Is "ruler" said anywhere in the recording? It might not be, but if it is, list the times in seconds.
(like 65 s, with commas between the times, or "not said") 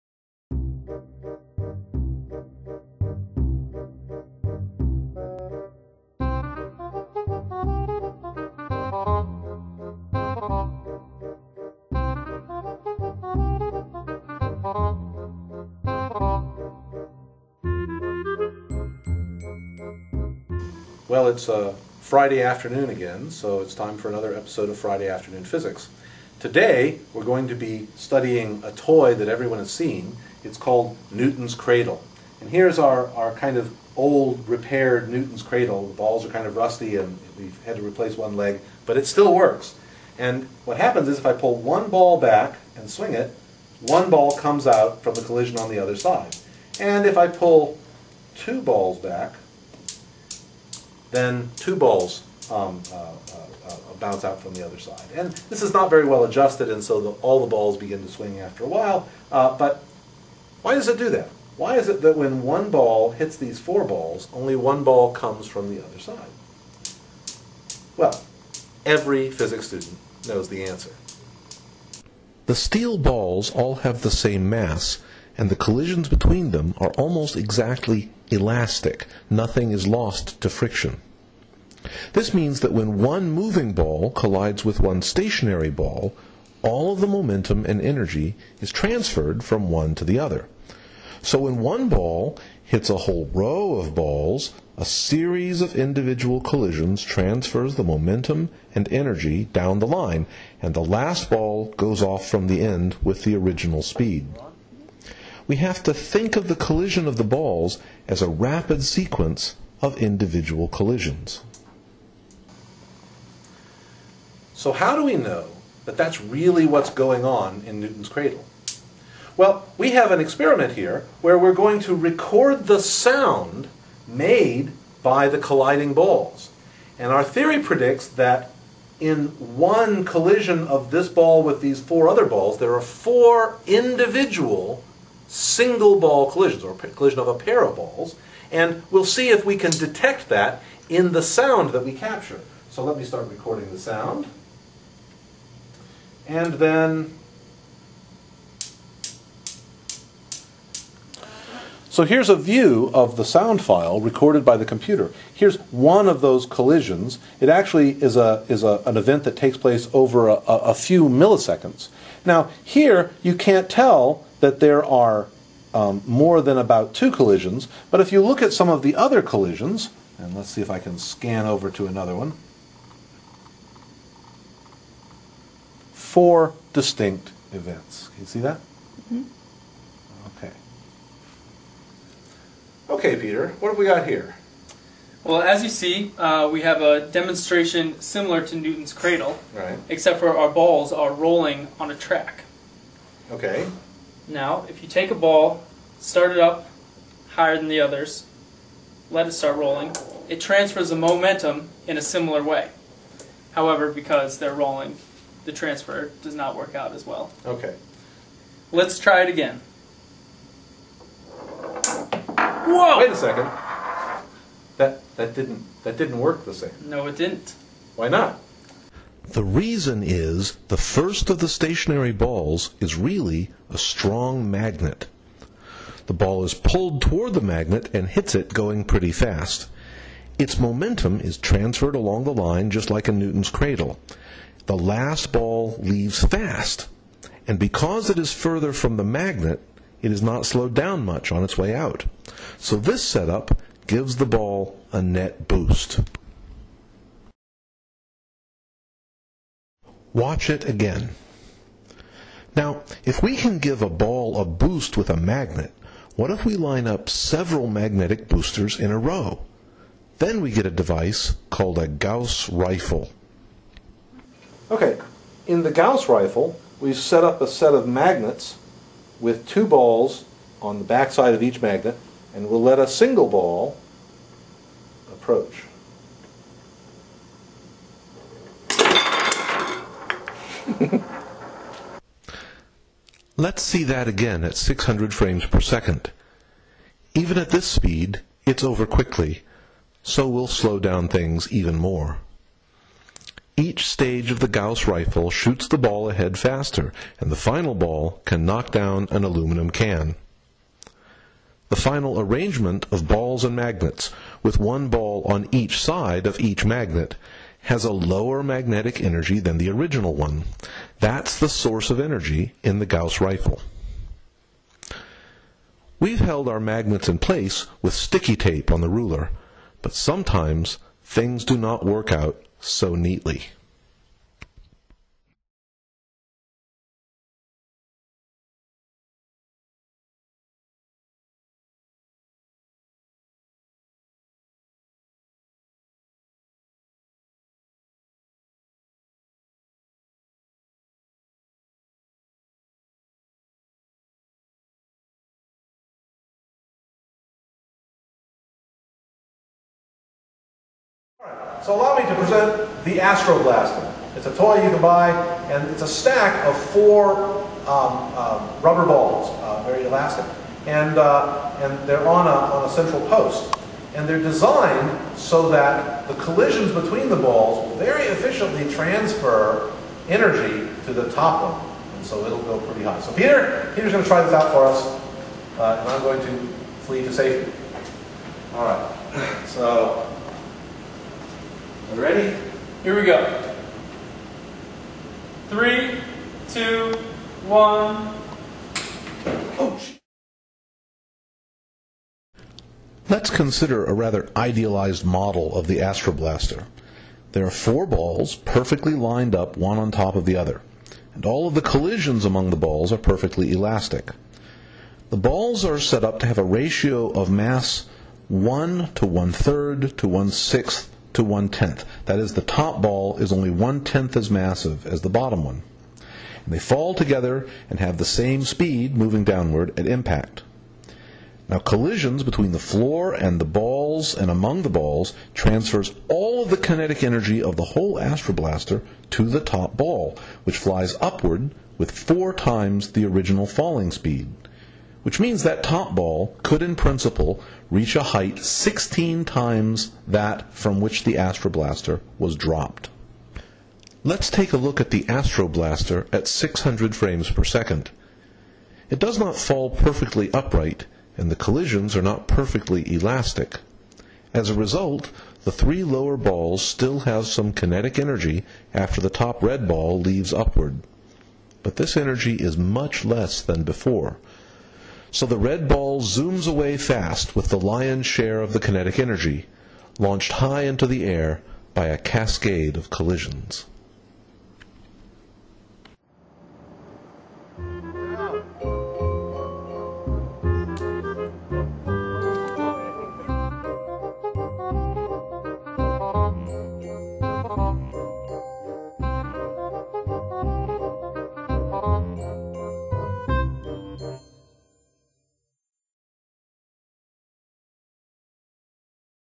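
318 s.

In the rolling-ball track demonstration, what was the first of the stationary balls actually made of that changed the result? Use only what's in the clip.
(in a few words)
a strong magnet.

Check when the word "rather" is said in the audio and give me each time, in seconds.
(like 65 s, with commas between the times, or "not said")
393 s.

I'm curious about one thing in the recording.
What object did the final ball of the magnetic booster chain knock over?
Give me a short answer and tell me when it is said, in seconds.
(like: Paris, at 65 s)
an aluminum can, at 299 s.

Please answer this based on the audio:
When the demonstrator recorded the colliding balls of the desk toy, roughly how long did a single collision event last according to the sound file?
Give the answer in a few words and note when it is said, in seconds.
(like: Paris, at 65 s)
a few milliseconds, at 160 s.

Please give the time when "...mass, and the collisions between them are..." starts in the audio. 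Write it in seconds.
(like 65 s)
74 s.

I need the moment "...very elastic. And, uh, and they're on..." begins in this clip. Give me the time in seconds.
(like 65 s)
359 s.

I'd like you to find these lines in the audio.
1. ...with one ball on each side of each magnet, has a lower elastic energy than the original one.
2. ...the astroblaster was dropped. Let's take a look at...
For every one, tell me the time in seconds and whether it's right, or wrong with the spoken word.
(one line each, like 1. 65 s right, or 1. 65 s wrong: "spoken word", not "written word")
1. 304 s wrong: "magnetic", not "elastic"
2. 441 s right.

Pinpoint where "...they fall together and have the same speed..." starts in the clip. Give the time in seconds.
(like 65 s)
416 s.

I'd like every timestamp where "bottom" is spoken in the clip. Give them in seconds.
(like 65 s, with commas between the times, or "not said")
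415 s.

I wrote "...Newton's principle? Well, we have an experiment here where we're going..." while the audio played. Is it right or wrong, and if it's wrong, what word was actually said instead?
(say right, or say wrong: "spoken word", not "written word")
wrong: "cradle", not "principle".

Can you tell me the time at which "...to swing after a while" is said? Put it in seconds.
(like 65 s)
58 s.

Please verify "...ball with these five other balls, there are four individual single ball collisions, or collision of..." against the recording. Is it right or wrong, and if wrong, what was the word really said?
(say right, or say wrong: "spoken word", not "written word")
wrong: "four", not "five".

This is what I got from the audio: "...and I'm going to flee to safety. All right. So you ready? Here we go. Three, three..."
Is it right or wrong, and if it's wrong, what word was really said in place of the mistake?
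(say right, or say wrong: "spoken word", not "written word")
wrong: "two", not "three".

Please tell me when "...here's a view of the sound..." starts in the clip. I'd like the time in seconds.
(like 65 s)
152 s.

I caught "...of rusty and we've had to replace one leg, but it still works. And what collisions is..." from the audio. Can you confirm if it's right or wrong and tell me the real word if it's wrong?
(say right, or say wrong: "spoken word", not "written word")
wrong: "happens", not "collisions".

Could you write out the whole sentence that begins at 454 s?
As a result, the three lower balls still have some kinetic energy after the top red ball leaves upward.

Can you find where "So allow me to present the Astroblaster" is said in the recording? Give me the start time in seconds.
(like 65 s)
351 s.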